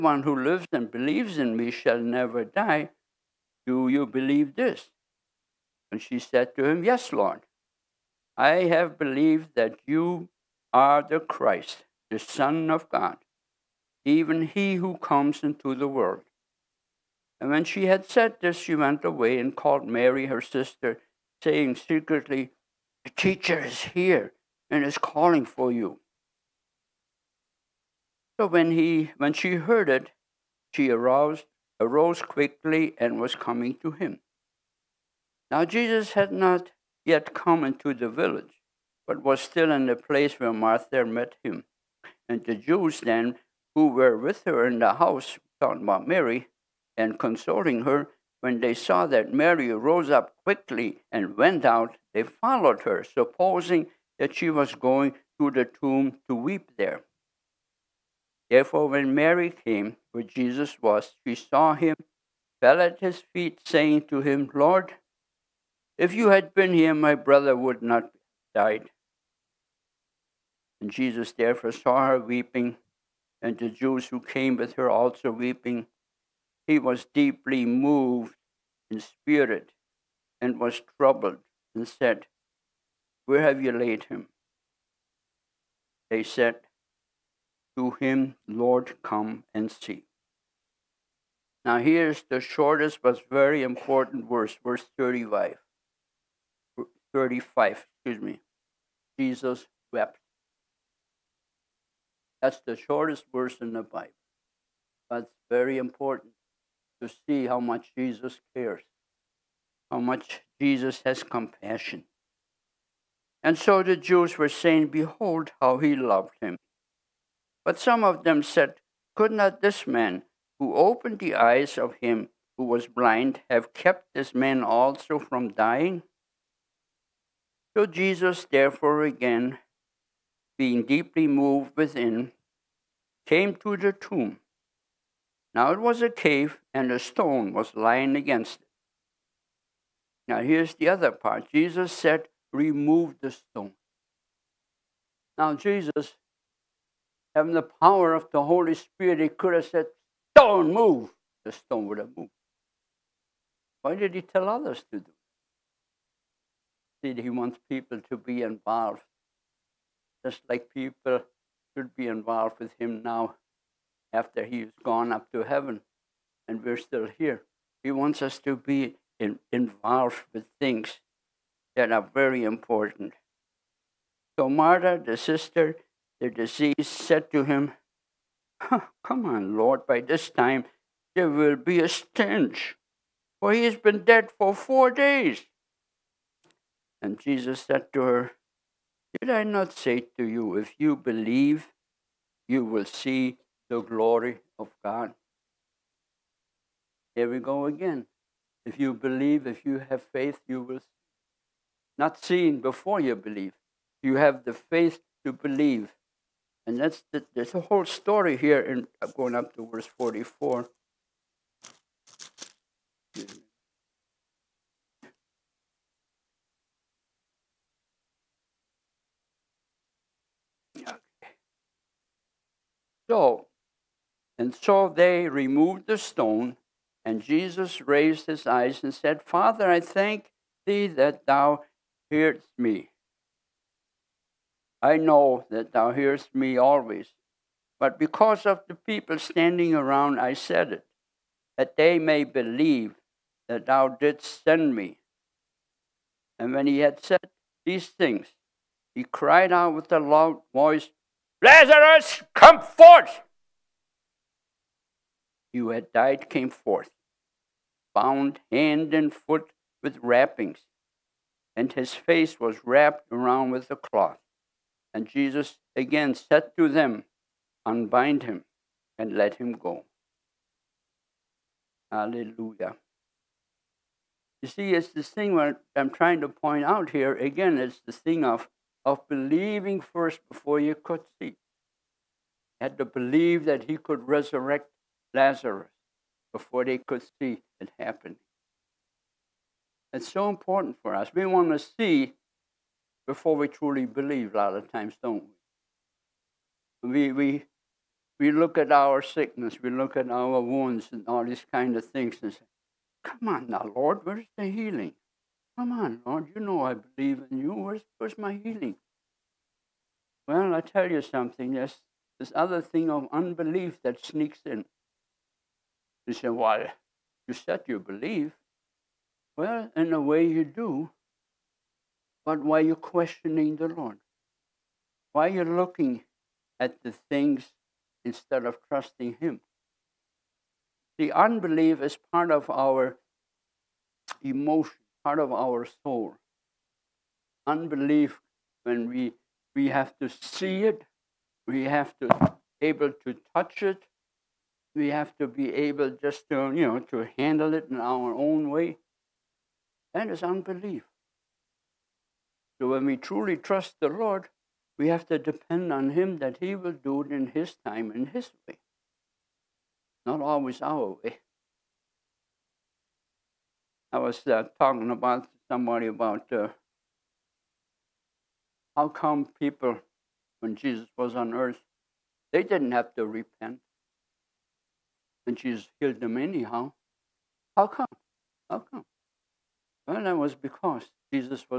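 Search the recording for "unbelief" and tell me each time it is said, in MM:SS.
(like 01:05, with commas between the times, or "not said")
05:13, 05:31, 05:37, 05:50.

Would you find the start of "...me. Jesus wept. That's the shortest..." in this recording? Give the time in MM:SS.
01:38.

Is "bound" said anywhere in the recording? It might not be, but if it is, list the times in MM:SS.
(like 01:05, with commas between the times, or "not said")
04:17.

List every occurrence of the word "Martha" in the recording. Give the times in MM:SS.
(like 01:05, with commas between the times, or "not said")
00:40, 02:54.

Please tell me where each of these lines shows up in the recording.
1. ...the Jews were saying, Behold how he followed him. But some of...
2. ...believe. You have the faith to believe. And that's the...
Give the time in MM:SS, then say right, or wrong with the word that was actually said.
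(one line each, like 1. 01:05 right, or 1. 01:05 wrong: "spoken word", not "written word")
1. 01:53 wrong: "loved", not "followed"
2. 03:23 right.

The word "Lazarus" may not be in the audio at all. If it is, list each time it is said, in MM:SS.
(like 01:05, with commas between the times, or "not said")
04:11, 04:45.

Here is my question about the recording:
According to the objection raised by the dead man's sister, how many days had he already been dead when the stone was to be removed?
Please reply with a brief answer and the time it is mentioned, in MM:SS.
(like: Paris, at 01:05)
4, at 03:04.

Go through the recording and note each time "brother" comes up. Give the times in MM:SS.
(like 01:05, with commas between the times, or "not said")
01:07.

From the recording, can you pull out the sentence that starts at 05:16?
You say, Well, you said you believe.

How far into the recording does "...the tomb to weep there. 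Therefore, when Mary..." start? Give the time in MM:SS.
00:55.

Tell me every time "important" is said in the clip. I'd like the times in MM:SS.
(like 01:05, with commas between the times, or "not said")
01:33, 01:45, 02:52, 04:50.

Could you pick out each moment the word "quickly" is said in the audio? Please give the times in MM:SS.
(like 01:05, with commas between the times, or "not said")
00:32, 00:50.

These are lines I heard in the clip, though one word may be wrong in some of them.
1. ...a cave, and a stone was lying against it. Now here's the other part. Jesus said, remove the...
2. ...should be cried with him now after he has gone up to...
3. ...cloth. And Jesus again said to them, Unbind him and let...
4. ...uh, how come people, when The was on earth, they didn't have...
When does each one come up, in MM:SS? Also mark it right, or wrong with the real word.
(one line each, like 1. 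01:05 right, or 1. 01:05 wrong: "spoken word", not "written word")
1. 02:16 right
2. 02:41 wrong: "involved", not "cried"
3. 04:23 right
4. 06:06 wrong: "Jesus", not "The".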